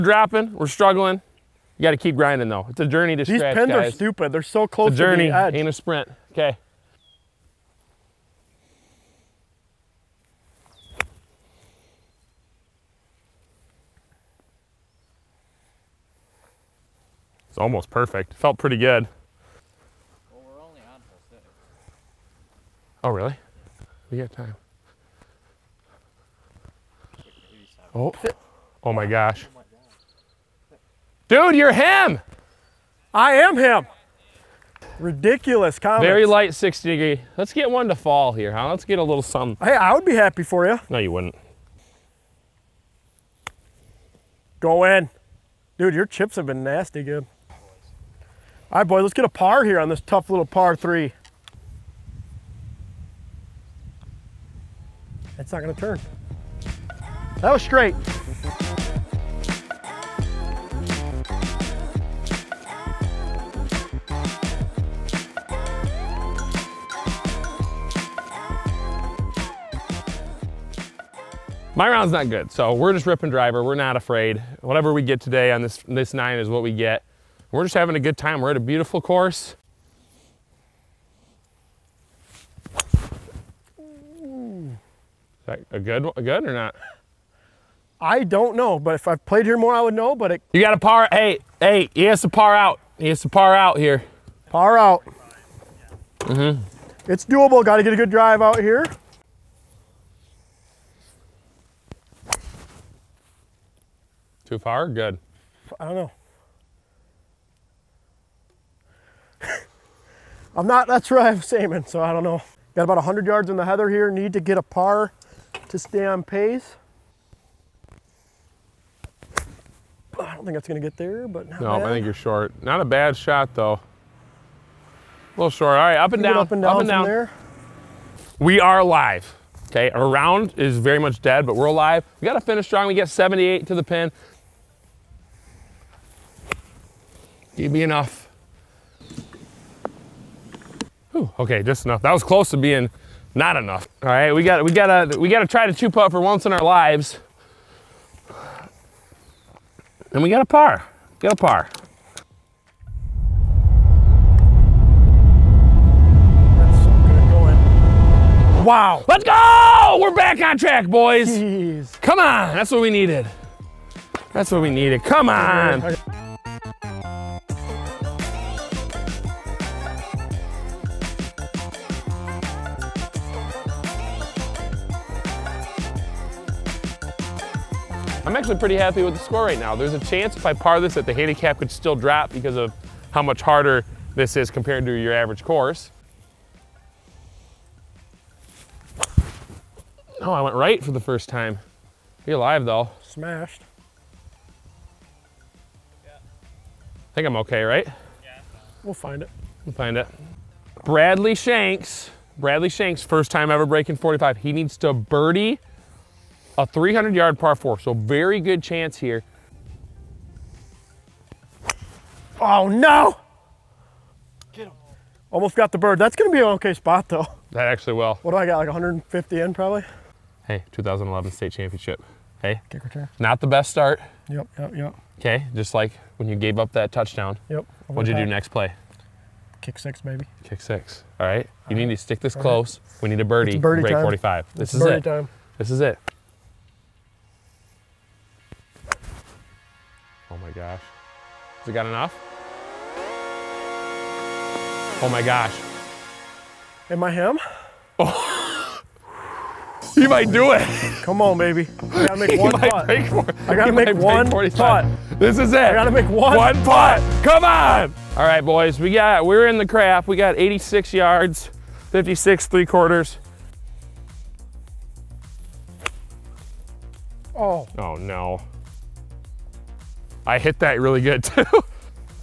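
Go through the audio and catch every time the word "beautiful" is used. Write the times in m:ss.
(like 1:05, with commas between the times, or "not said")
1:18.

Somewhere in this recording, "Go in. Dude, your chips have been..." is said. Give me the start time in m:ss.
0:44.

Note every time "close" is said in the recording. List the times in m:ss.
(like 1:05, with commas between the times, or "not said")
0:04, 2:22, 3:52.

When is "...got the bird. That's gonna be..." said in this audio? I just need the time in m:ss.
3:35.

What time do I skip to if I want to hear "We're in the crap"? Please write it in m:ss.
4:19.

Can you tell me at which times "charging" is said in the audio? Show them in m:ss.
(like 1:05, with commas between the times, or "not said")
not said.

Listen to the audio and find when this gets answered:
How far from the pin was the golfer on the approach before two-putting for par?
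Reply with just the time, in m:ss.
2:13.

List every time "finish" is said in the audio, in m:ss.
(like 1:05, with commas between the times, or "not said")
2:12.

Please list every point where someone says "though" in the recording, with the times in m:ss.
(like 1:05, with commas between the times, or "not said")
0:02, 2:03, 3:12, 3:37.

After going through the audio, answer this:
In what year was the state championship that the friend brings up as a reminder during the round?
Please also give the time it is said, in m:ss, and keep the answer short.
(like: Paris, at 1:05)
2011, at 3:40.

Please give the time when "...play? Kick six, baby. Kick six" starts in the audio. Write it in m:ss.
3:48.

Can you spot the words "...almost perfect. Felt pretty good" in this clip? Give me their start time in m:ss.
0:17.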